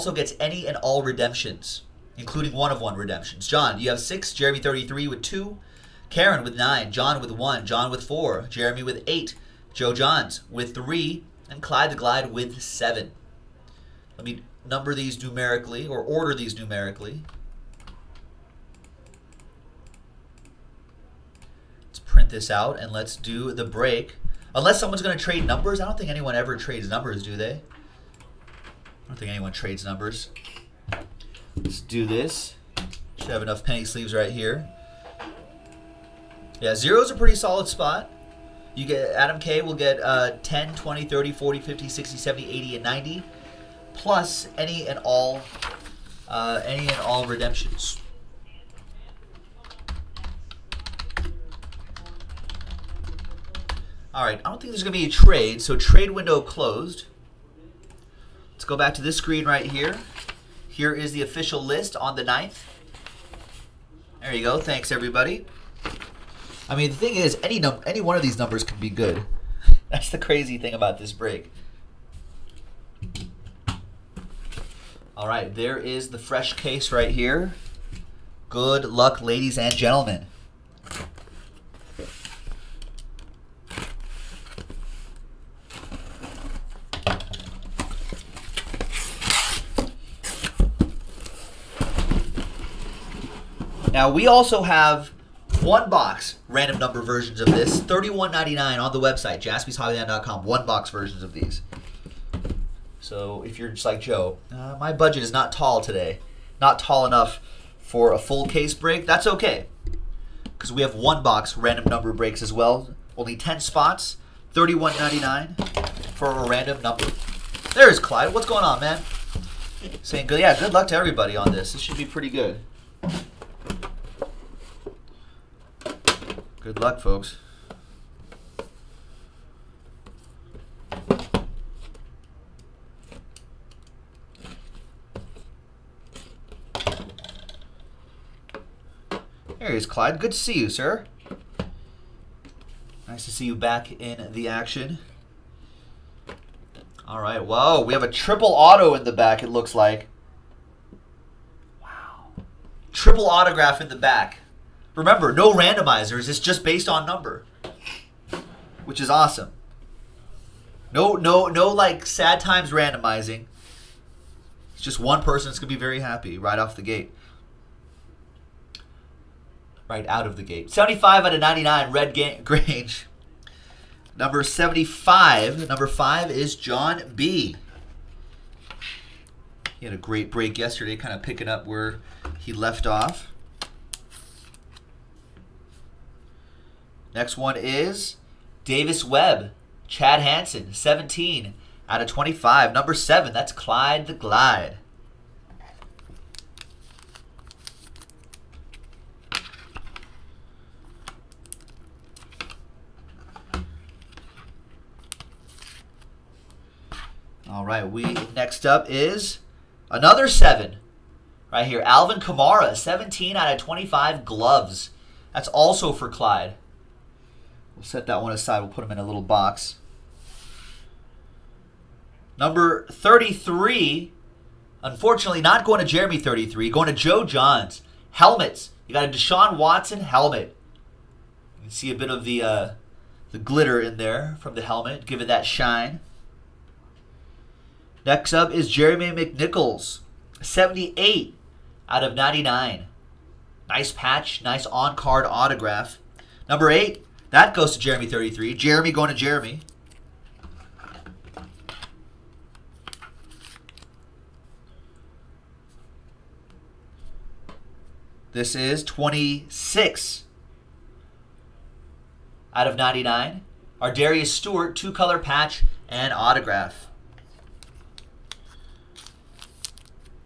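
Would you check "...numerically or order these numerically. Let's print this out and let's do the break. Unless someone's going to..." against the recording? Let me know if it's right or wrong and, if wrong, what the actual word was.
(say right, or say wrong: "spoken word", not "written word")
right.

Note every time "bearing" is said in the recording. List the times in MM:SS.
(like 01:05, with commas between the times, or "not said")
not said.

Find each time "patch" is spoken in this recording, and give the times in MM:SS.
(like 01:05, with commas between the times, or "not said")
04:03, 04:25.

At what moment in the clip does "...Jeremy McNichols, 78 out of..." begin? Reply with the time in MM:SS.
03:58.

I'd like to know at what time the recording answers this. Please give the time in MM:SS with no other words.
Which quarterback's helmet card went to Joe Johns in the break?
03:49.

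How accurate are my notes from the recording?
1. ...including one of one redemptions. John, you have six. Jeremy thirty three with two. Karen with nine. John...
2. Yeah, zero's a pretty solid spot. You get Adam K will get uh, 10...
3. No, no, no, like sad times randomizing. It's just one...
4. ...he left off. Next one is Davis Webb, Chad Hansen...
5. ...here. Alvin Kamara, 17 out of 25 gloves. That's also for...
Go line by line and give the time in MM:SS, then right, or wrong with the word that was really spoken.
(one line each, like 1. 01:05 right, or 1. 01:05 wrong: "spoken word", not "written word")
1. 00:02 right
2. 00:36 right
3. 02:40 right
4. 03:02 right
5. 03:31 right.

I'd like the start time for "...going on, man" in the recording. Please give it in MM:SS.
01:58.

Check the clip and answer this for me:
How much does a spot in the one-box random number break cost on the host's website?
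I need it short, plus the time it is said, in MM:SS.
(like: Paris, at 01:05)
$31.99, at 01:37.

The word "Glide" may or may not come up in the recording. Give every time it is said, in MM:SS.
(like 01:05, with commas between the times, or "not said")
00:11, 03:14.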